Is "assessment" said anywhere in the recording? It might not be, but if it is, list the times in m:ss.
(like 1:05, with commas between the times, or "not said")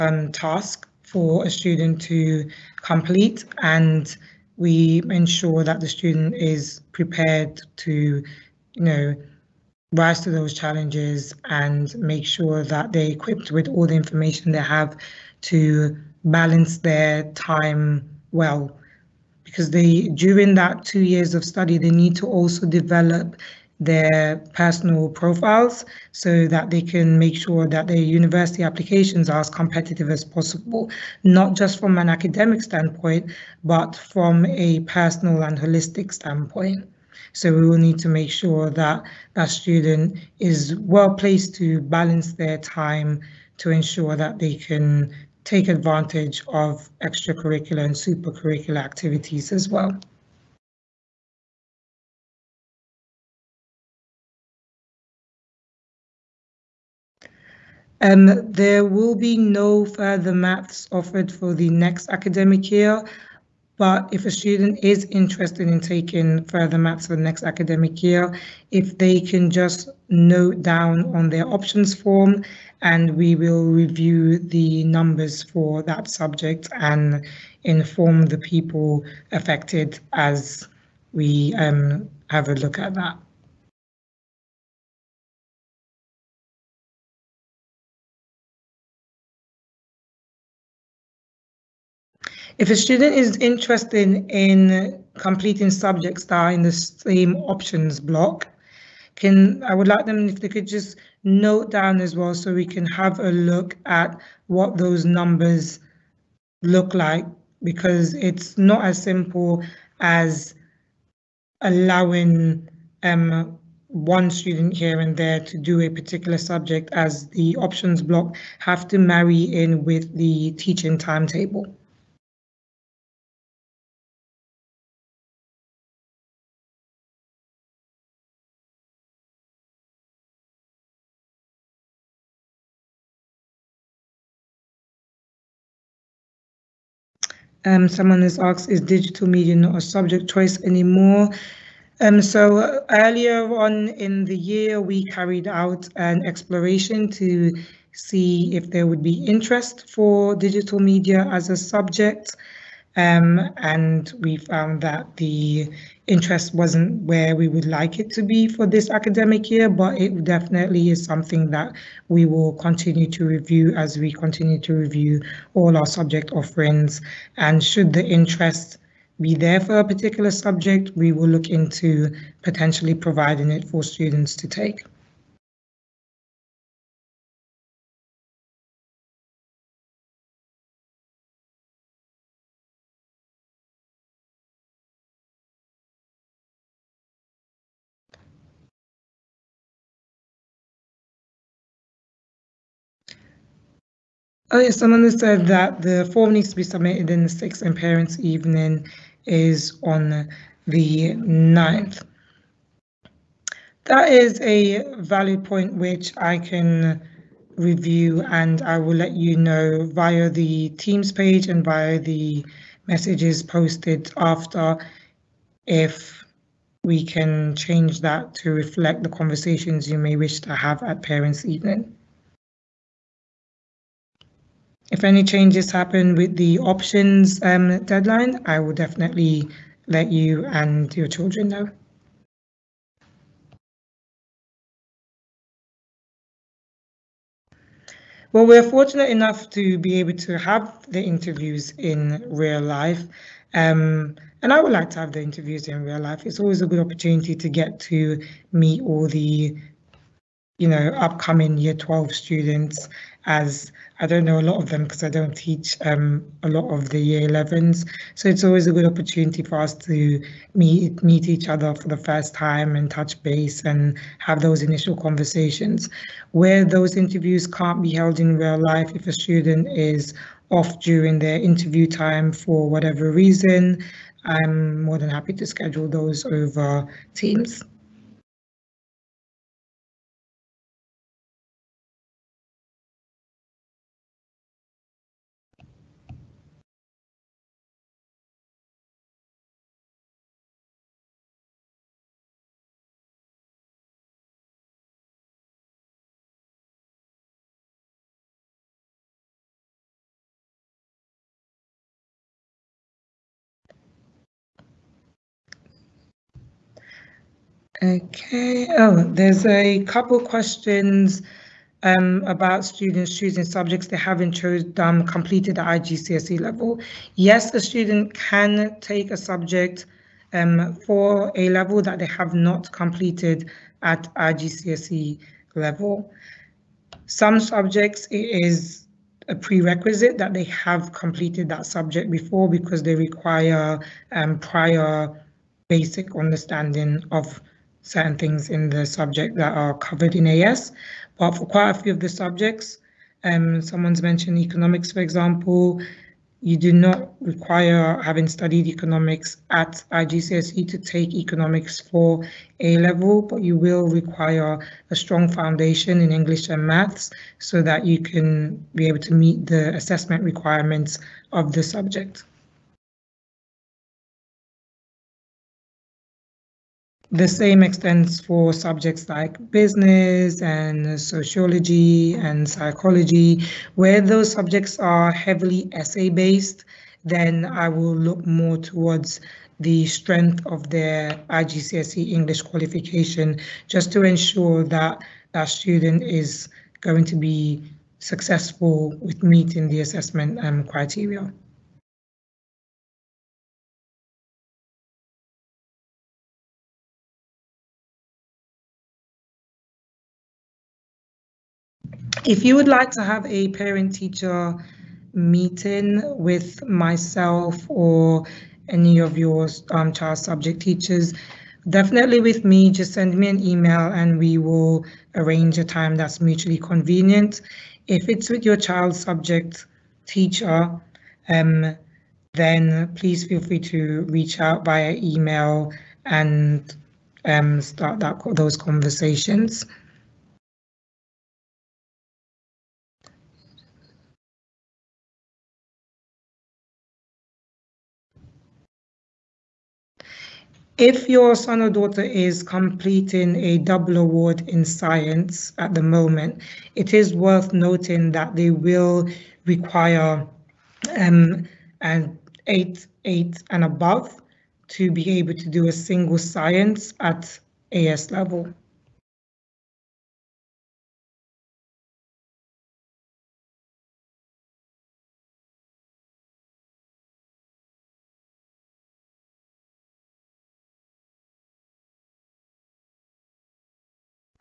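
5:59, 6:29.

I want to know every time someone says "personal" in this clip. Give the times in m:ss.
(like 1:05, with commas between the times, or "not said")
0:24, 0:34.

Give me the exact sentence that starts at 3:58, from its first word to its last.
Well, we're fortunate enough to be able to have the interviews in real life.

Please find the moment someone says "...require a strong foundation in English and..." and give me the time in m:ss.
5:53.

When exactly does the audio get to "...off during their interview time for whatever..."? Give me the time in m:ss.
4:30.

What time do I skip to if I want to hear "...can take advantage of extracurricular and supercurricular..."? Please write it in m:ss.
0:44.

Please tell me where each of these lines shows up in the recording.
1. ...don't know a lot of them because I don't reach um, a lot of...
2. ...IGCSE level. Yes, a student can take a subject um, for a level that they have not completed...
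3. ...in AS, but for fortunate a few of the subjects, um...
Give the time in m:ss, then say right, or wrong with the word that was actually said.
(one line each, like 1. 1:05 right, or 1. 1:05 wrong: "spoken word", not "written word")
1. 4:14 wrong: "teach", not "reach"
2. 5:15 right
3. 5:40 wrong: "quite", not "fortunate".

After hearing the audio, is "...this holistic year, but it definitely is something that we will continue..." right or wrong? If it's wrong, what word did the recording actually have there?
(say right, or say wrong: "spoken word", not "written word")
wrong: "academic", not "holistic".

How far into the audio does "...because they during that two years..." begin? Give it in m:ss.
0:19.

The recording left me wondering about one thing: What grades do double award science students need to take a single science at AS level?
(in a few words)
8, 8 and above.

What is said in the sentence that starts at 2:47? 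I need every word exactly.
And should the interest be there for a particular subject, we will look into potentially providing it for students to take.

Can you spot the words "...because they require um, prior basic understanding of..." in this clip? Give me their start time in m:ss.
5:32.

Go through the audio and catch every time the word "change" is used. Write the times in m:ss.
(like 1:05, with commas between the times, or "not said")
3:37, 3:45.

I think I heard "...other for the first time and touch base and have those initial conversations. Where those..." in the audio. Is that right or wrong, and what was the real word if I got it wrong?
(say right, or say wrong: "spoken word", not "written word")
right.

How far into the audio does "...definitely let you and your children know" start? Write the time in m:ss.
3:48.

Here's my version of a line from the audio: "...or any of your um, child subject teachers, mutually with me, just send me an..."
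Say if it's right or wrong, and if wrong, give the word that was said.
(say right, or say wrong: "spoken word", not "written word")
wrong: "definitely", not "mutually".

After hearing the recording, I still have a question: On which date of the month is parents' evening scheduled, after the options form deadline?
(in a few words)
9th.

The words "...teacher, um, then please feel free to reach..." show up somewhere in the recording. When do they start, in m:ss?
7:00.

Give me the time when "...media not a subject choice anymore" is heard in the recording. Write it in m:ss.
2:19.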